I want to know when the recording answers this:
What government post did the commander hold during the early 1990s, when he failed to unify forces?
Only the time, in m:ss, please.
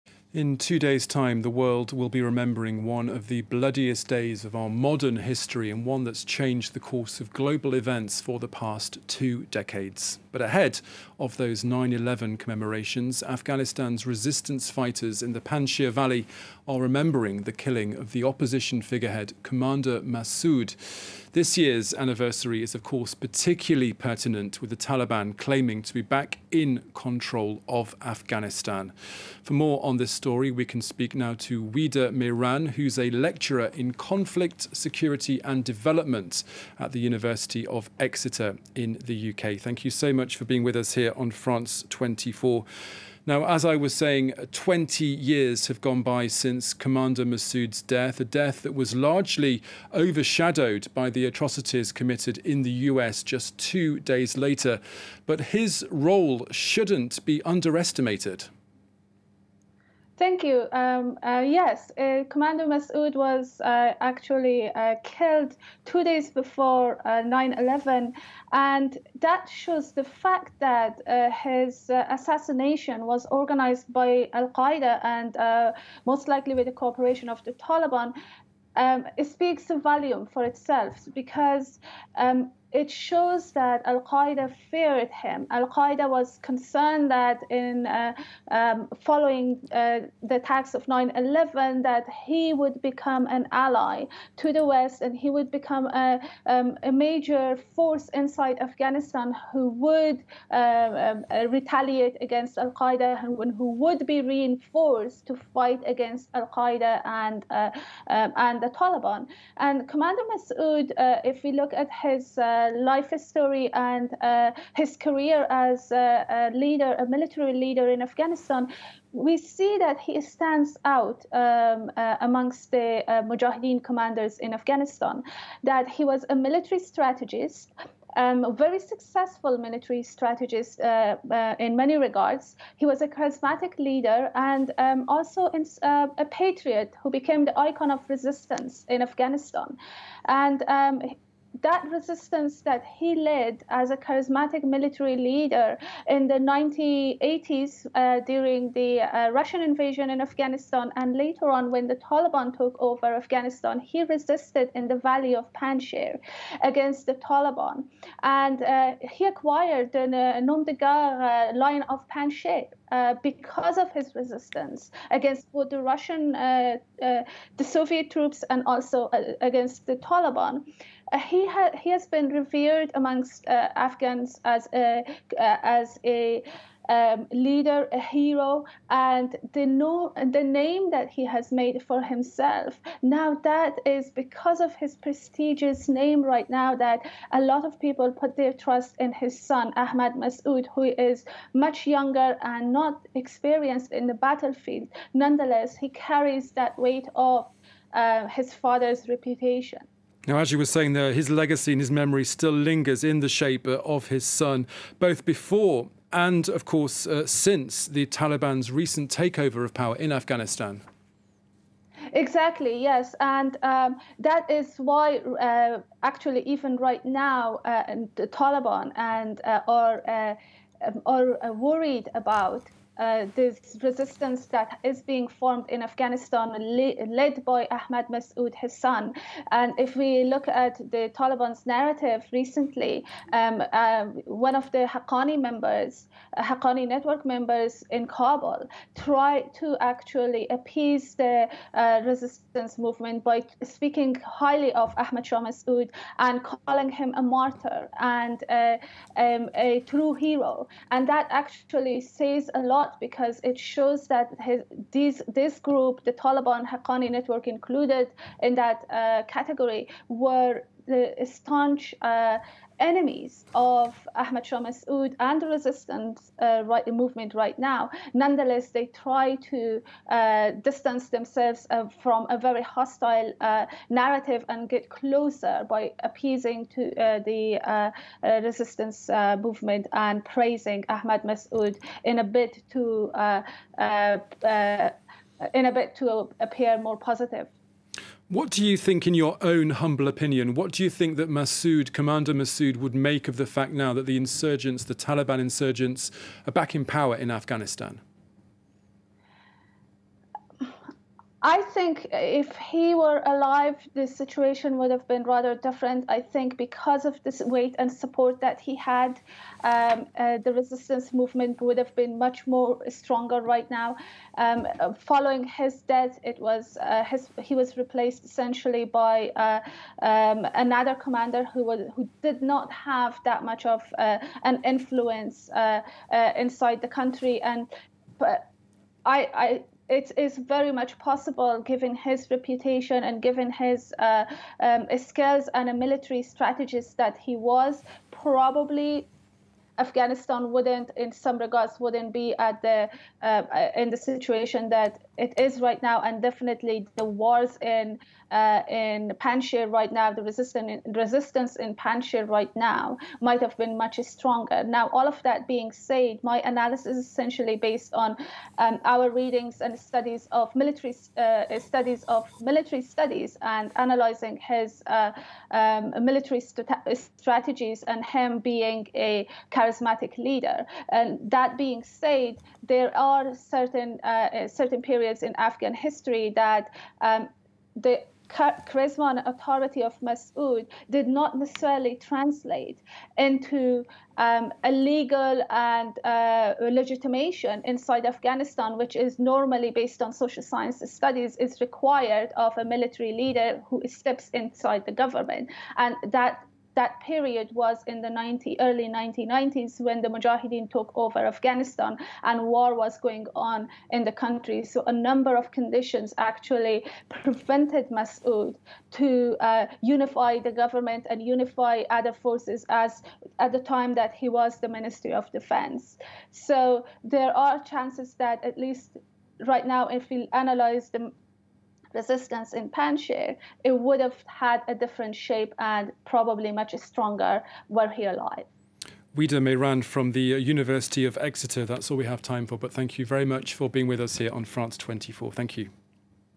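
6:54.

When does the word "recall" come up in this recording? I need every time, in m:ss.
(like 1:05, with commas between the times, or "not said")
not said.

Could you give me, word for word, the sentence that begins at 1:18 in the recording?
Um, it speaks a volume for itself because um, it shows that Al Qaeda feared him.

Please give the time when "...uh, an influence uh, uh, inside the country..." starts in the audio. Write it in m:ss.
5:23.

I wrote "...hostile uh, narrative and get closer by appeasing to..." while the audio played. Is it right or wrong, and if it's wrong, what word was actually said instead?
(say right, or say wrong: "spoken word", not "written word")
right.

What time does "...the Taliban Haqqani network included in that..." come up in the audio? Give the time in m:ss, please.
4:16.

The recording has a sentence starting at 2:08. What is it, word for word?
Um, a very successful military strategist uh, uh, in many regards.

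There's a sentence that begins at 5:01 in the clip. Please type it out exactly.
I think if he were alive, the situation would have been rather different.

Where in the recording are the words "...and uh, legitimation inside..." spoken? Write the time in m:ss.
6:25.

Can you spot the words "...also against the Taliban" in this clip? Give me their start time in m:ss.
2:48.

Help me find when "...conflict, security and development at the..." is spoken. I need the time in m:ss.
0:33.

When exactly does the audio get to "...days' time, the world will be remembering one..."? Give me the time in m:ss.
0:00.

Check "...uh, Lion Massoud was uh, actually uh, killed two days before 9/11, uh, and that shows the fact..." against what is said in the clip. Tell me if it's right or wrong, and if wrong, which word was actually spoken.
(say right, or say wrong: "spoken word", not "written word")
wrong: "Commander", not "Lion".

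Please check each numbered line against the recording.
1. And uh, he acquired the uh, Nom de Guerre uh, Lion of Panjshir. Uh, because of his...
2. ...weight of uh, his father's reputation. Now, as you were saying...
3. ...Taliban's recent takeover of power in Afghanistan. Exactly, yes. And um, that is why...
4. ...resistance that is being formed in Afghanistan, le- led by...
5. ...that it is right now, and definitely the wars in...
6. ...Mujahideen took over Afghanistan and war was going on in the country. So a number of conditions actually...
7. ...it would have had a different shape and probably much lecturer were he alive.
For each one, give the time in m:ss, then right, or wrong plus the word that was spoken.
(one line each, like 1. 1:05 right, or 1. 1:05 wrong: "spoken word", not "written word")
1. 2:38 right
2. 3:16 right
3. 3:28 right
4. 3:43 right
5. 5:44 right
6. 6:40 right
7. 7:03 wrong: "stronger", not "lecturer".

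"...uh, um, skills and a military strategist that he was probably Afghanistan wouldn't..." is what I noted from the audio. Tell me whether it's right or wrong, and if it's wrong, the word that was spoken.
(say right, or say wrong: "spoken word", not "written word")
right.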